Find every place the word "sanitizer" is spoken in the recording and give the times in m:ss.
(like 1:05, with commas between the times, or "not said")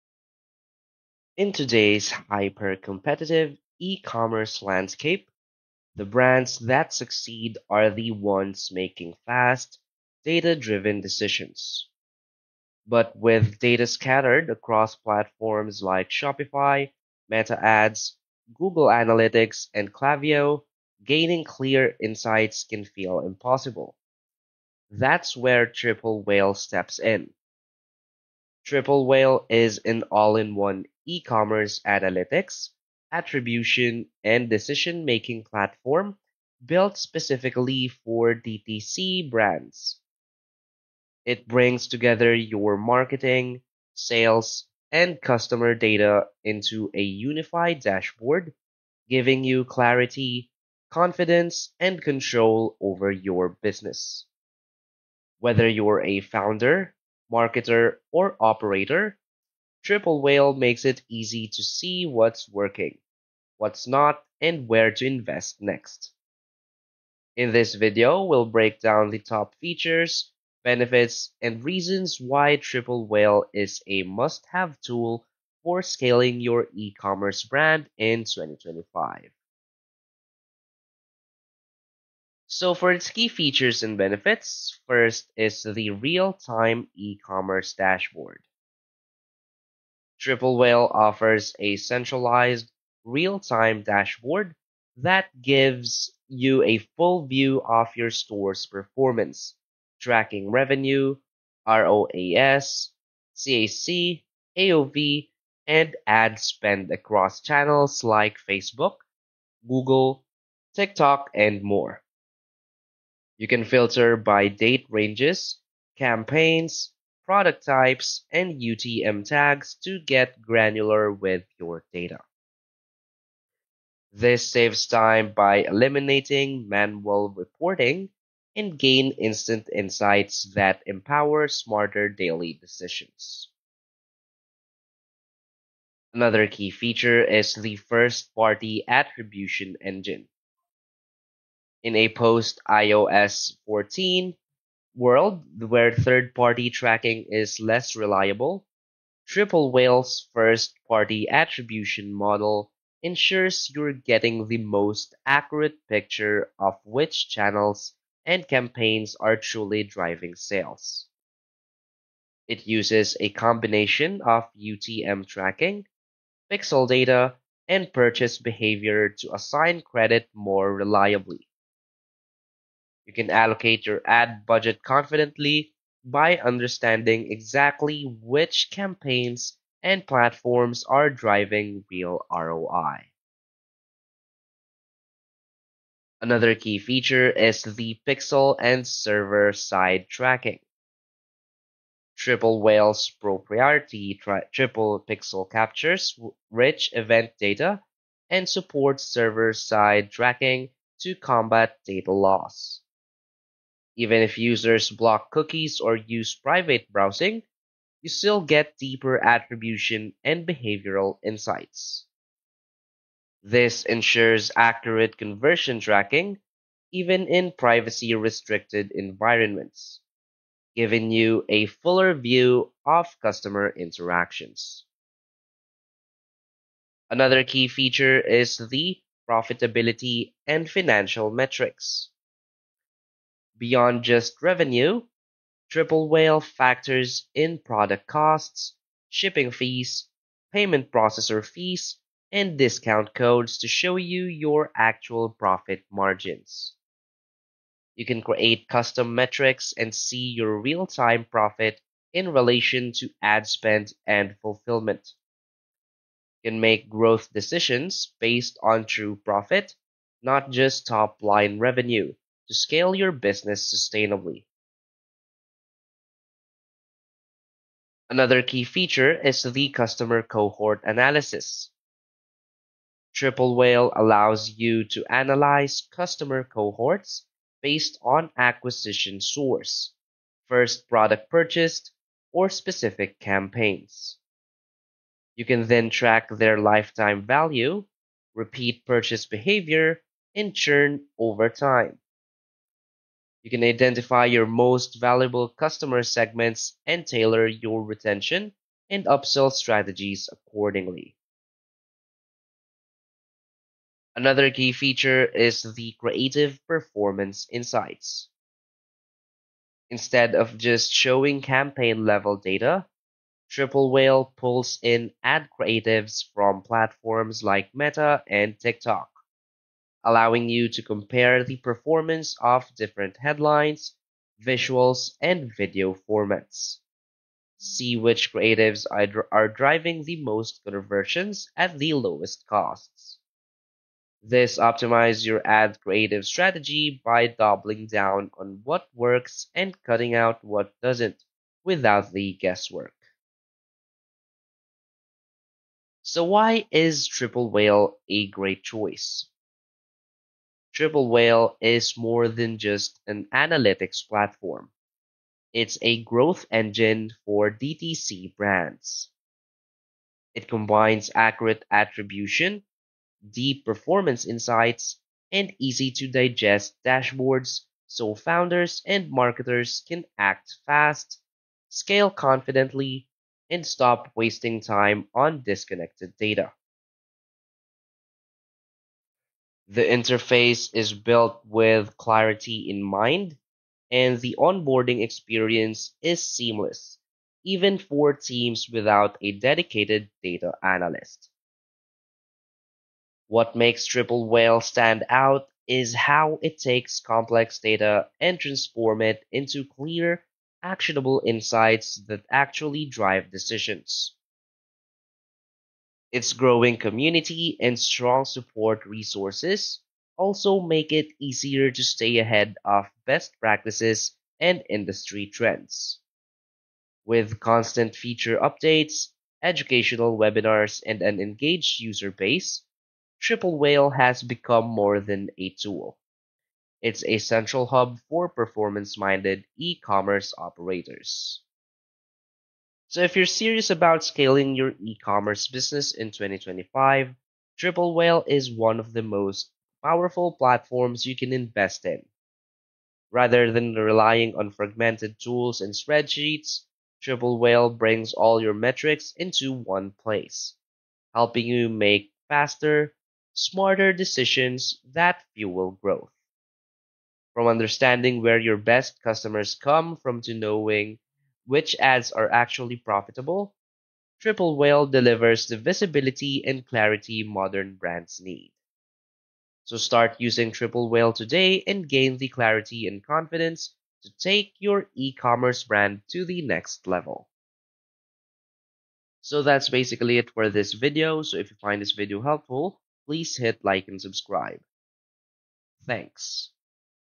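not said.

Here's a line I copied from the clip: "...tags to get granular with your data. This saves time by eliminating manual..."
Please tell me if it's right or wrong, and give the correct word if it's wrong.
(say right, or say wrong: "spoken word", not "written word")
right.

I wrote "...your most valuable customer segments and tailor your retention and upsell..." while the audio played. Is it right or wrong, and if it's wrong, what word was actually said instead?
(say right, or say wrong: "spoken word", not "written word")
right.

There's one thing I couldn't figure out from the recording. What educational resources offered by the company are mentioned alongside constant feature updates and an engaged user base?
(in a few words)
educational webinars.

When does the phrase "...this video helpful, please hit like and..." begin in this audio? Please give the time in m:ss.
8:01.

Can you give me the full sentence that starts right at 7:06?
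It's a central hub for performance minded e commerce operators.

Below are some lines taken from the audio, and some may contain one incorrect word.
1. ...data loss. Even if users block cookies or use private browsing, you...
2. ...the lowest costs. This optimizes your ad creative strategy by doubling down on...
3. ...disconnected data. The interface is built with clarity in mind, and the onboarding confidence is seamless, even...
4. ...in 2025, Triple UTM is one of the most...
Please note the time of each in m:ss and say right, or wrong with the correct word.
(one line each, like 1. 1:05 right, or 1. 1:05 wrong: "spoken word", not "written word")
1. 3:21 right
2. 5:31 right
3. 6:15 wrong: "experience", not "confidence"
4. 7:15 wrong: "Whale", not "UTM".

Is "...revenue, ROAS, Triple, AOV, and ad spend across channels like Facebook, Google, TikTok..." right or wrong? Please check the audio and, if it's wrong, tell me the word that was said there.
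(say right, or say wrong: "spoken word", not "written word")
wrong: "CAC", not "Triple".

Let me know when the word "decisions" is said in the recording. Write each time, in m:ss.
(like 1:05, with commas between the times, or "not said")
0:10, 0:34, 2:12, 4:17, 6:43, 7:33.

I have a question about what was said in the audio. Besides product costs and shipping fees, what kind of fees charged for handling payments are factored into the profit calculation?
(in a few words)
payment processor fees.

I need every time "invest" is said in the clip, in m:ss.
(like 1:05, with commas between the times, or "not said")
1:05, 7:21.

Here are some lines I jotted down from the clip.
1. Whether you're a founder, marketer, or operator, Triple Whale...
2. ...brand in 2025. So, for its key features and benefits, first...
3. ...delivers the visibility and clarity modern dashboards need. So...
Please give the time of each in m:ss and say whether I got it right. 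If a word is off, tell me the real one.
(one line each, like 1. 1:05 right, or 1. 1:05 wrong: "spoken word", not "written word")
1. 0:55 right
2. 1:17 right
3. 7:44 wrong: "brands", not "dashboards".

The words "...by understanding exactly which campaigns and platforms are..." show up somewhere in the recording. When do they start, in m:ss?
2:56.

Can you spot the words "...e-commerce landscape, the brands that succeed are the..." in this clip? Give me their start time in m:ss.
0:03.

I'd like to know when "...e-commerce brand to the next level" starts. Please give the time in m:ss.
7:54.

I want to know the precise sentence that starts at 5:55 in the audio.
It's a growth engine for DTC brands.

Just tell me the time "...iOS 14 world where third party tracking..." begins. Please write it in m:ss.
2:22.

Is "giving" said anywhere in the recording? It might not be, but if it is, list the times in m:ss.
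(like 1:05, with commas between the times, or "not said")
0:49, 3:40.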